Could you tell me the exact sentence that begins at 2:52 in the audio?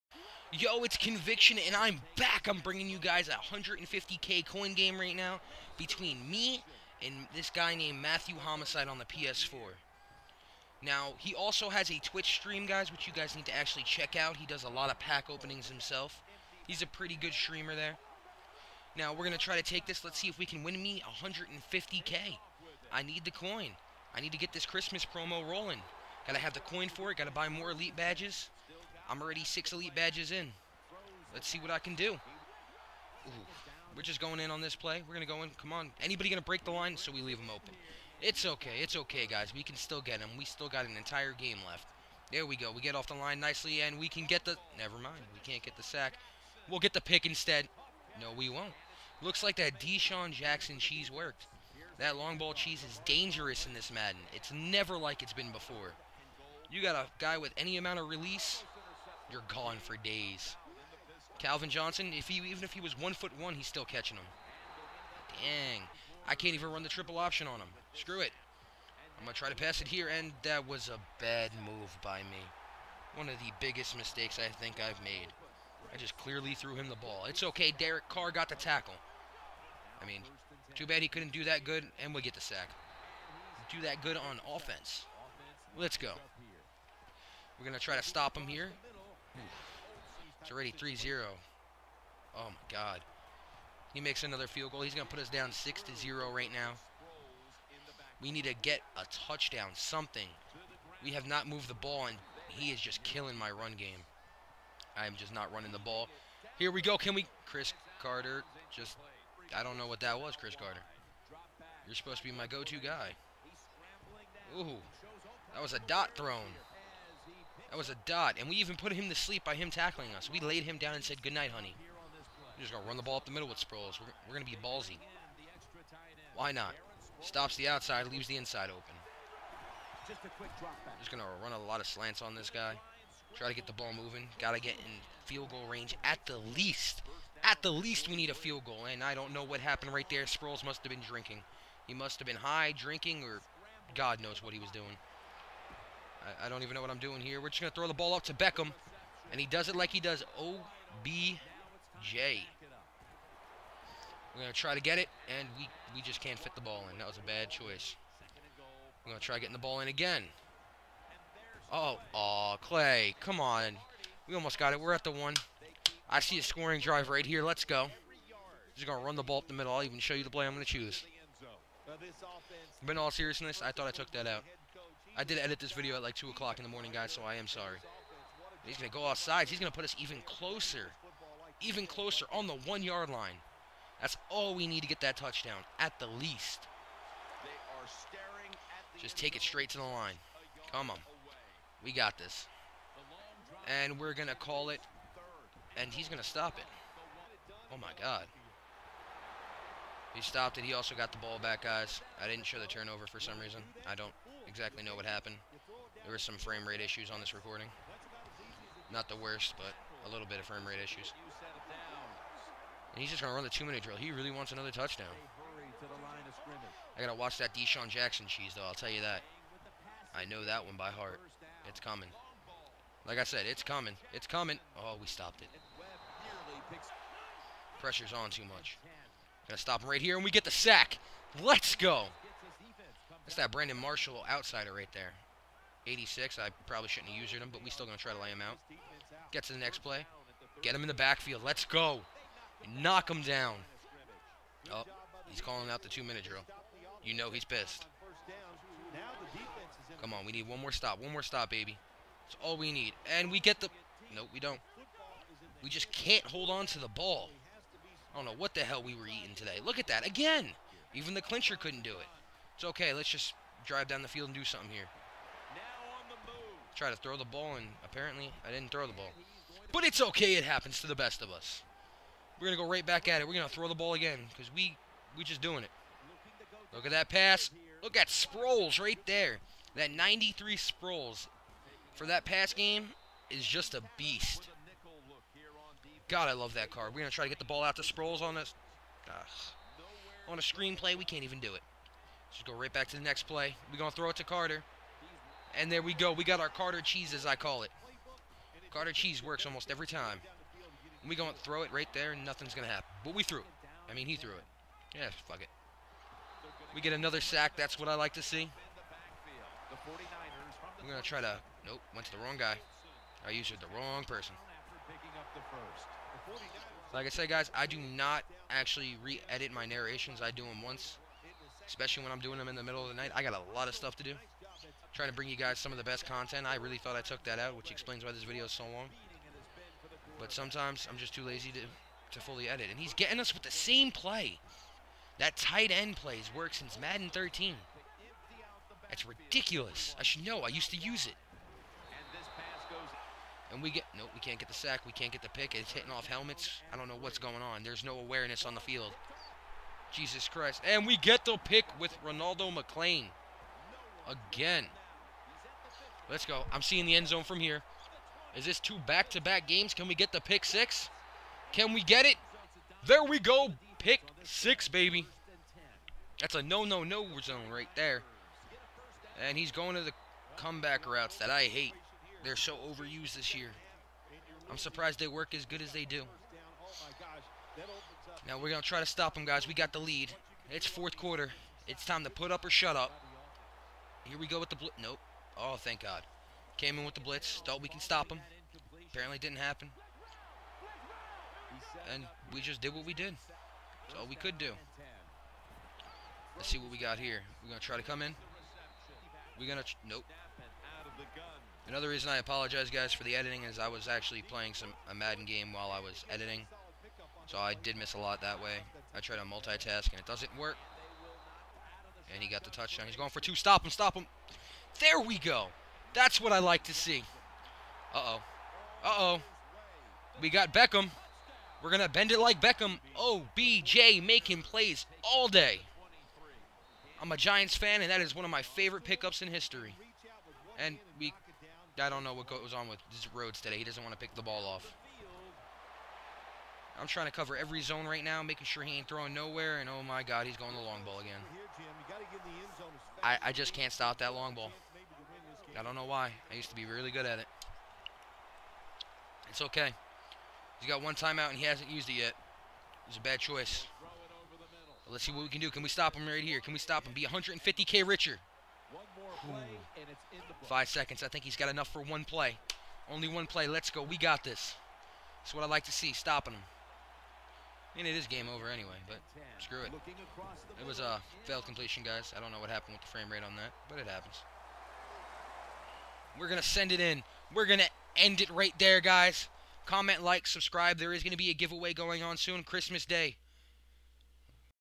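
But in all seriousness, I thought I took that out.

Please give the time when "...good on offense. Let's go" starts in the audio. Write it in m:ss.
1:24.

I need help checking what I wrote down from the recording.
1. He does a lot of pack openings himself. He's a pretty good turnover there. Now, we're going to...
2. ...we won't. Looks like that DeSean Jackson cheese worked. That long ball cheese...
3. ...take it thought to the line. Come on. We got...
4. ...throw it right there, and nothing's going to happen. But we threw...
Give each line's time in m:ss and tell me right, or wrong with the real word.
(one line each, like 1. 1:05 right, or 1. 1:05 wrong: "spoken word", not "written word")
1. 0:14 wrong: "streamer", not "turnover"
2. 0:48 right
3. 3:09 wrong: "straight", not "thought"
4. 5:01 right.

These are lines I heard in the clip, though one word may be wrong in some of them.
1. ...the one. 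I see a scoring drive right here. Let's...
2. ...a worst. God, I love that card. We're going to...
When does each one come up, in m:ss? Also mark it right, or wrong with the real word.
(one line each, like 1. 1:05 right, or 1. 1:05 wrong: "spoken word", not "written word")
1. 2:45 right
2. 4:43 wrong: "beast", not "worst".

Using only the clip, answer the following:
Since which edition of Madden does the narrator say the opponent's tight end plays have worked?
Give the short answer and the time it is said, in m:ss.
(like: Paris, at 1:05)
Madden 13, at 5:36.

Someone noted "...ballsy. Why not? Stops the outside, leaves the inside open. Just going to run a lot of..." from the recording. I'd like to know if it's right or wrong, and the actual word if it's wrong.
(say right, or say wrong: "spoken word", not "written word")
right.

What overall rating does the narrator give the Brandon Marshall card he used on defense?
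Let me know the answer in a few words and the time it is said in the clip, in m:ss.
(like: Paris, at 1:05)
86, at 3:55.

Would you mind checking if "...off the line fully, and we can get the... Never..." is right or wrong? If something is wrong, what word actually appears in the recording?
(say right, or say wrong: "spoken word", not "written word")
wrong: "nicely", not "fully".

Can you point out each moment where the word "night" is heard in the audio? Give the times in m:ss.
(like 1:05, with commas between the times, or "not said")
2:01, 5:22.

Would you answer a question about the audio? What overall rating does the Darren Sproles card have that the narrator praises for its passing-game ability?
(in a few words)
93.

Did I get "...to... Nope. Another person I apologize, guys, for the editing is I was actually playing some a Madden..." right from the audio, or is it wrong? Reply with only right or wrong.
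wrong.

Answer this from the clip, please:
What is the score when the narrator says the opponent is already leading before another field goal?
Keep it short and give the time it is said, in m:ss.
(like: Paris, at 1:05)
3-0, at 1:30.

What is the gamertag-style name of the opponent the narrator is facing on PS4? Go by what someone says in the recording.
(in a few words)
Matthew Homicide.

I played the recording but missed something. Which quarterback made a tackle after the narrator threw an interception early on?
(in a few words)
Derek Carr.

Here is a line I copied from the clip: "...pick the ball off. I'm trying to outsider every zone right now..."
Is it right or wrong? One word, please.
wrong.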